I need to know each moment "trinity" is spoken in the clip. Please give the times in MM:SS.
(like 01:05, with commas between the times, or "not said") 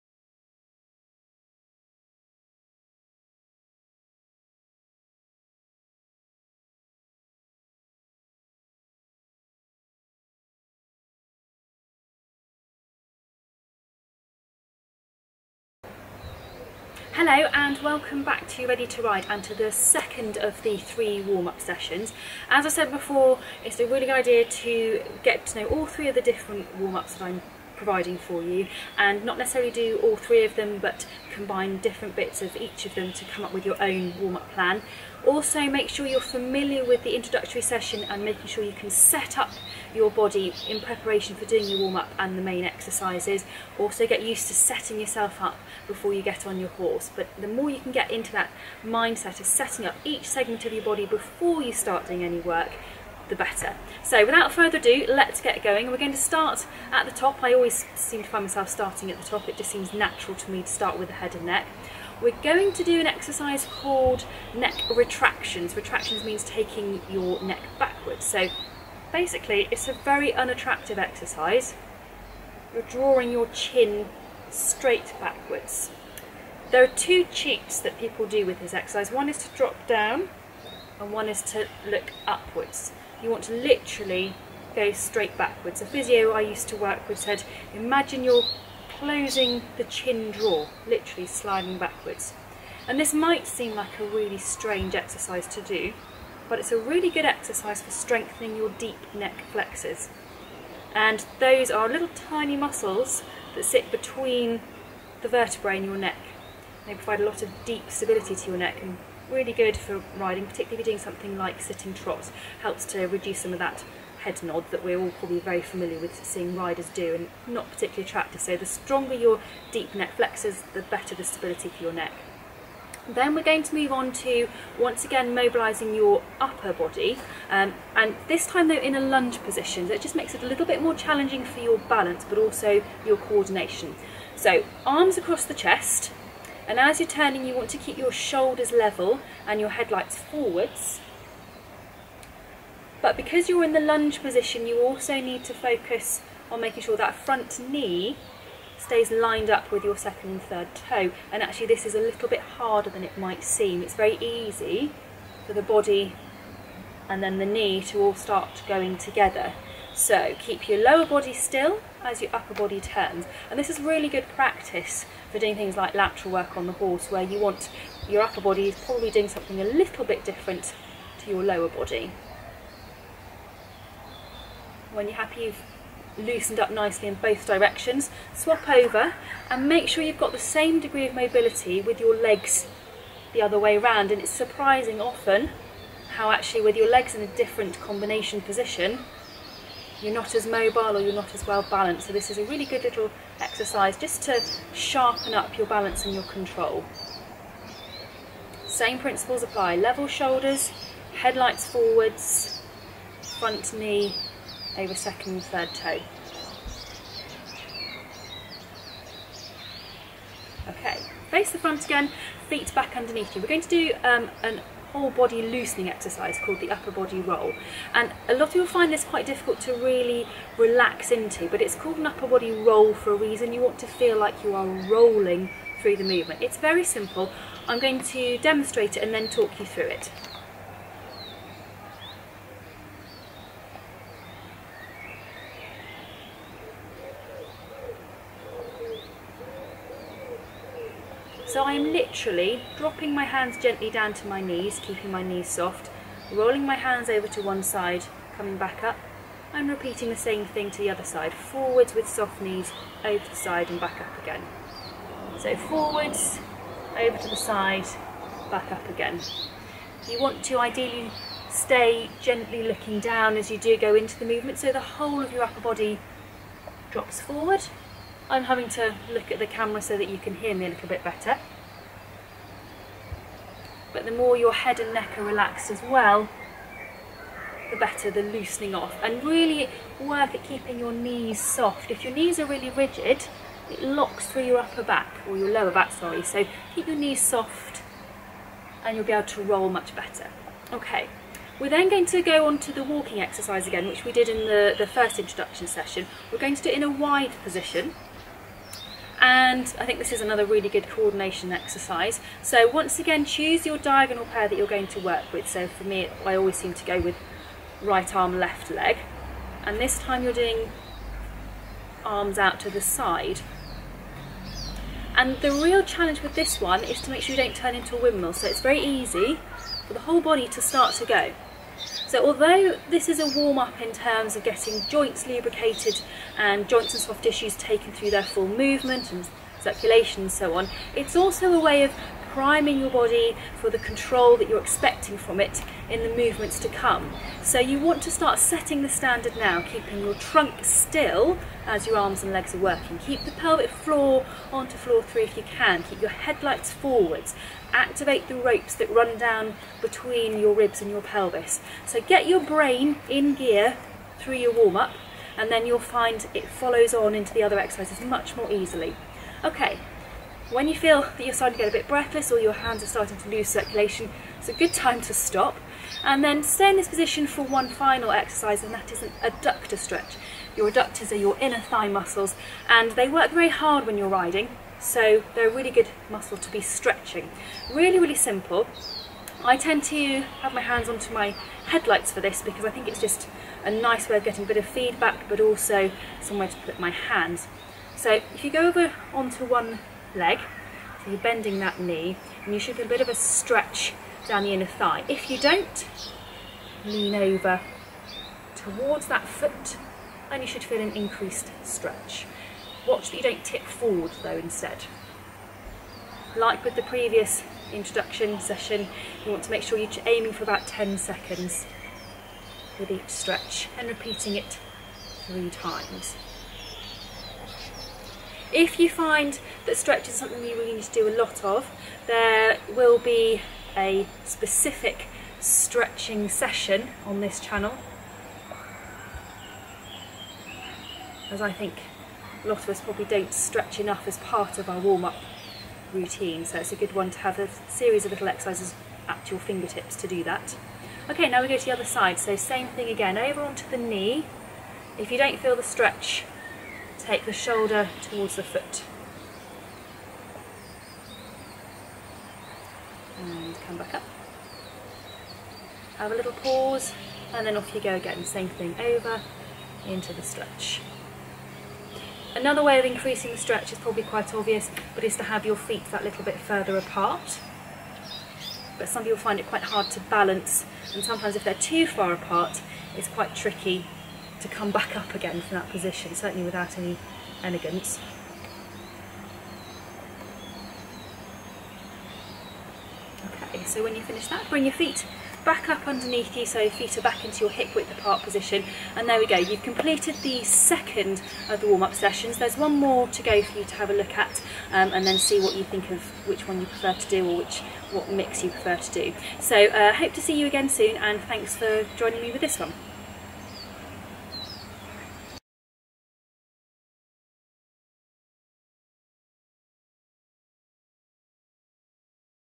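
not said.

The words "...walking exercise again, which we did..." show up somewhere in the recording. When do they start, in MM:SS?
04:52.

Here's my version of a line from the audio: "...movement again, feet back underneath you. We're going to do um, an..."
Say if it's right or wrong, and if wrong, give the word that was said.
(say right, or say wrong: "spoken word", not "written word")
wrong: "front", not "movement".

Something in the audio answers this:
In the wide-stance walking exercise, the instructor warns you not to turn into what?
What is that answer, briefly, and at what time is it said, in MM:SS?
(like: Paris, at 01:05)
A windmill, at 05:18.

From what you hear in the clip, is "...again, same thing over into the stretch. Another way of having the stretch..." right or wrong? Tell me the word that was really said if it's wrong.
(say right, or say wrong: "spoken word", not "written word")
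wrong: "increasing", not "having".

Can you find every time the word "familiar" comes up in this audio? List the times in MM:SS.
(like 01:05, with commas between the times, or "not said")
00:36, 01:55.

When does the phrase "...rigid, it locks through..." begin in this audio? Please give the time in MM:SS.
04:42.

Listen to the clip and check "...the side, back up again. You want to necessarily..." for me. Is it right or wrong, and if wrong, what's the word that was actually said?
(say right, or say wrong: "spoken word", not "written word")
wrong: "ideally", not "necessarily".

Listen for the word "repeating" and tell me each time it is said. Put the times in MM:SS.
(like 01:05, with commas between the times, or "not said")
04:09, 06:53.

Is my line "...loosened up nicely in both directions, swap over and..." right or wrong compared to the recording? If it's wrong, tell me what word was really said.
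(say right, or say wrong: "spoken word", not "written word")
right.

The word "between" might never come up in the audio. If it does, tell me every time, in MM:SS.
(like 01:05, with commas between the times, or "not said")
01:43, 05:49.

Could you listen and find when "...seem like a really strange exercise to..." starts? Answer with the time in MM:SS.
01:33.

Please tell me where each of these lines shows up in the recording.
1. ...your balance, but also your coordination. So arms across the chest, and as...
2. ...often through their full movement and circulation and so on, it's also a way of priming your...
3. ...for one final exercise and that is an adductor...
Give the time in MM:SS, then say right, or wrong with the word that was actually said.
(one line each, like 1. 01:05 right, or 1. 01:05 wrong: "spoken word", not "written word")
1. 02:11 right
2. 05:27 wrong: "taken", not "often"
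3. 06:07 right.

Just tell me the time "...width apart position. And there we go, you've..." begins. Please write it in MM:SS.
08:07.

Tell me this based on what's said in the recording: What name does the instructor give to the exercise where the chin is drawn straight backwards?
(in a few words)
Neck retractions.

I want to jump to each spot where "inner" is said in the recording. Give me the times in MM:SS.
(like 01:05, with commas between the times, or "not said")
06:11, 06:34.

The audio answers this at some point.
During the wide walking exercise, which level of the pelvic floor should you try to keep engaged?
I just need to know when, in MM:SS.
05:44.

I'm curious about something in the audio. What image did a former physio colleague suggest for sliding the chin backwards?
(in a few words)
Closing the chin drawer.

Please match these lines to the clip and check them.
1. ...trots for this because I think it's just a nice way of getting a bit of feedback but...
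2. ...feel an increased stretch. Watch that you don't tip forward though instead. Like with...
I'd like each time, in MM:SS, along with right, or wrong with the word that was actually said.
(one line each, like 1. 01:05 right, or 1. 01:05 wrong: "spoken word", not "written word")
1. 06:21 wrong: "headlights", not "trots"
2. 06:40 right.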